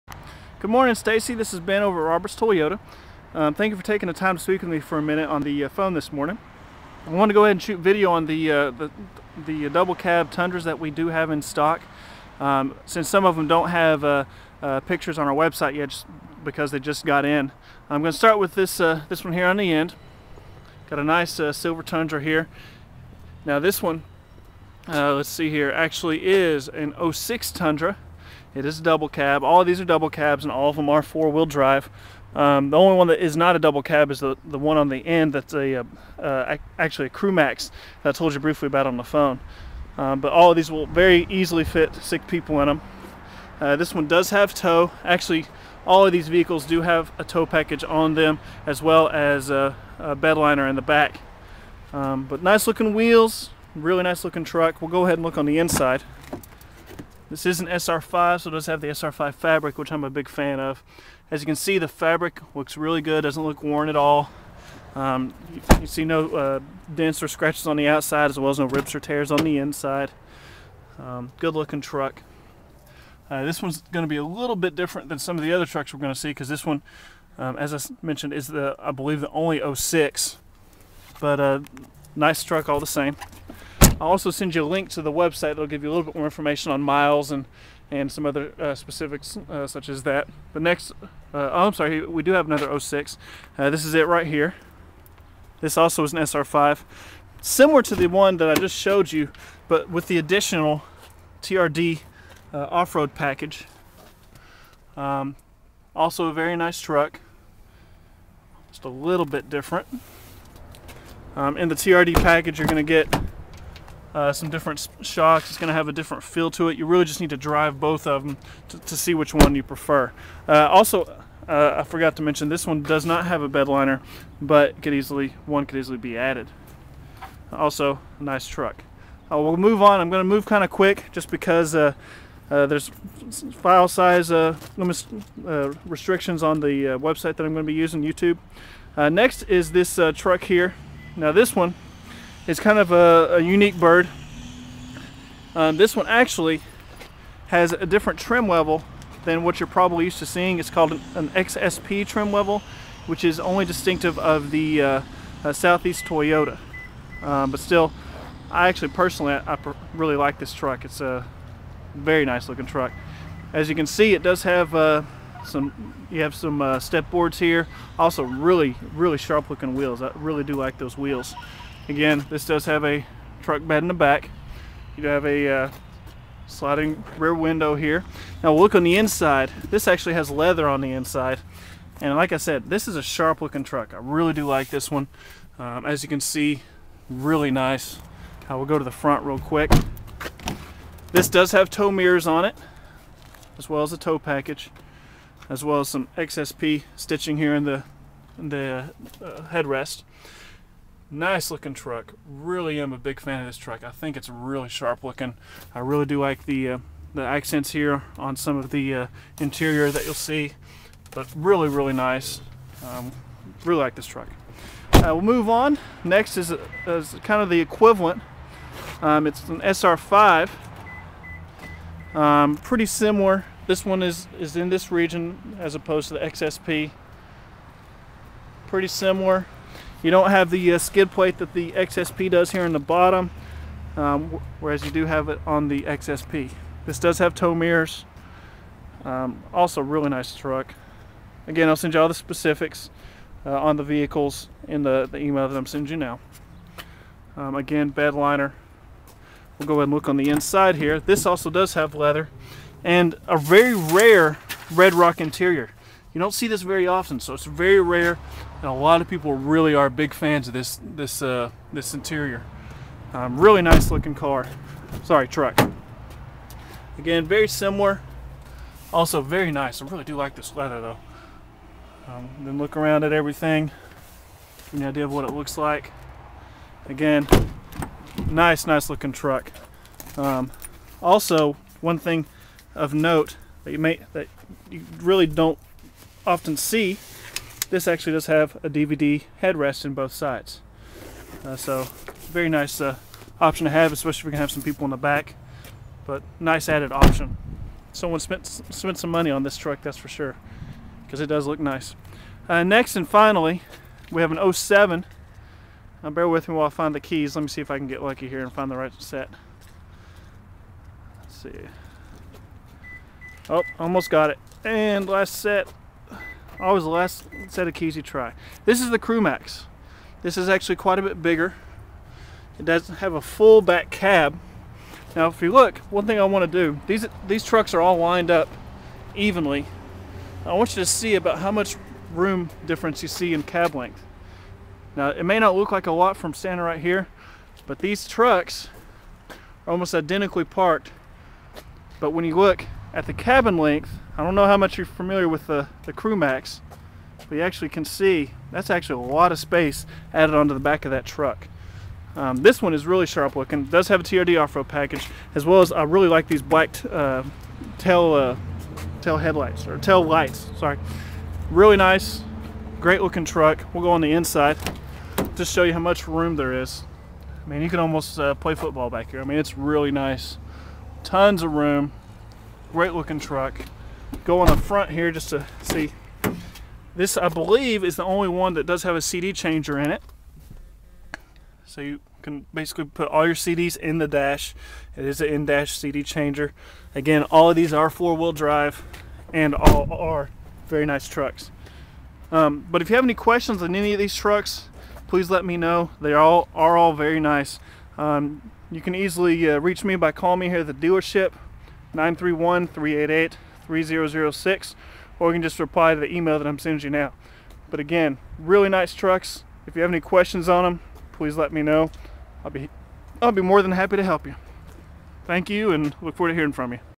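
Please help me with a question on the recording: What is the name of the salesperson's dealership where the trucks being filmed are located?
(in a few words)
Roberts Toyota.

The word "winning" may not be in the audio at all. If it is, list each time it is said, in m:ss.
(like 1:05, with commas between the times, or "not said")
not said.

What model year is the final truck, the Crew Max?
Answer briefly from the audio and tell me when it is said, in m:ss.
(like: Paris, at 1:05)
2007, at 5:04.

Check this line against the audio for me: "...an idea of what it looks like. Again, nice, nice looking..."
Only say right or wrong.
right.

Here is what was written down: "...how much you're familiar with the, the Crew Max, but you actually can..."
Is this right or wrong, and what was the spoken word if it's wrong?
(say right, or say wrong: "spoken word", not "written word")
right.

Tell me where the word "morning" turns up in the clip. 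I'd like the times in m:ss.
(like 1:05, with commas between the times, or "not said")
0:00, 0:06.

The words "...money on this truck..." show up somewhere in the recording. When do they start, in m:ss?
4:59.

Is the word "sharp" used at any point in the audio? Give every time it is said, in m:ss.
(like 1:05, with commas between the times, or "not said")
2:49, 3:03, 3:24, 5:53.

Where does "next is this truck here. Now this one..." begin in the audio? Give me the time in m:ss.
2:19.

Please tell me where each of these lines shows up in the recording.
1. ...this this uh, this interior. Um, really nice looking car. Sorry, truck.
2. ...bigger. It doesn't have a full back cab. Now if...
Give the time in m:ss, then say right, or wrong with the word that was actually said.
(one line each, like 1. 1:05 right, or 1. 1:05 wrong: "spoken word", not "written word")
1. 4:20 right
2. 5:21 right.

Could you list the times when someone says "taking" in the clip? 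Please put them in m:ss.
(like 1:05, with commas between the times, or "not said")
0:03.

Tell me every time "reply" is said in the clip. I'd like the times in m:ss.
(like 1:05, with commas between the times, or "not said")
6:45.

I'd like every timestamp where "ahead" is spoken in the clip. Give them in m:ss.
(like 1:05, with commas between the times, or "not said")
0:07, 0:55, 4:09.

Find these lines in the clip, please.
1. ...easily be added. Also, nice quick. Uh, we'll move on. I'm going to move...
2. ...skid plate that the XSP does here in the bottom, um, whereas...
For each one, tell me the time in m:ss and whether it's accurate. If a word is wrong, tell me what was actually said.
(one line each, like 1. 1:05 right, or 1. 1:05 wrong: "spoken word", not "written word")
1. 2:05 wrong: "truck", not "quick"
2. 3:50 right.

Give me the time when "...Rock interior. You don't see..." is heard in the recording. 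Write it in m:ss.
4:14.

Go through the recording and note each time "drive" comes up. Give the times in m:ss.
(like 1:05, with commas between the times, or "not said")
0:31, 1:57, 6:28.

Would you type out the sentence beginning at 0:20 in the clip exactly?
Got a nice silver Tundra here.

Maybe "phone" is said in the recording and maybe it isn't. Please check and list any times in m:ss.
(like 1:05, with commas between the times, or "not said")
0:05, 0:39.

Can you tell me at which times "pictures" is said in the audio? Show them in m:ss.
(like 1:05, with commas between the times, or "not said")
0:14.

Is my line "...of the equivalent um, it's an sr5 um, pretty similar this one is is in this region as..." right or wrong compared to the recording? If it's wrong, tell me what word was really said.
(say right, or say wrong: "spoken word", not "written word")
right.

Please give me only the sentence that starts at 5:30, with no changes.
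I want you to see about how much room difference you see in cab length.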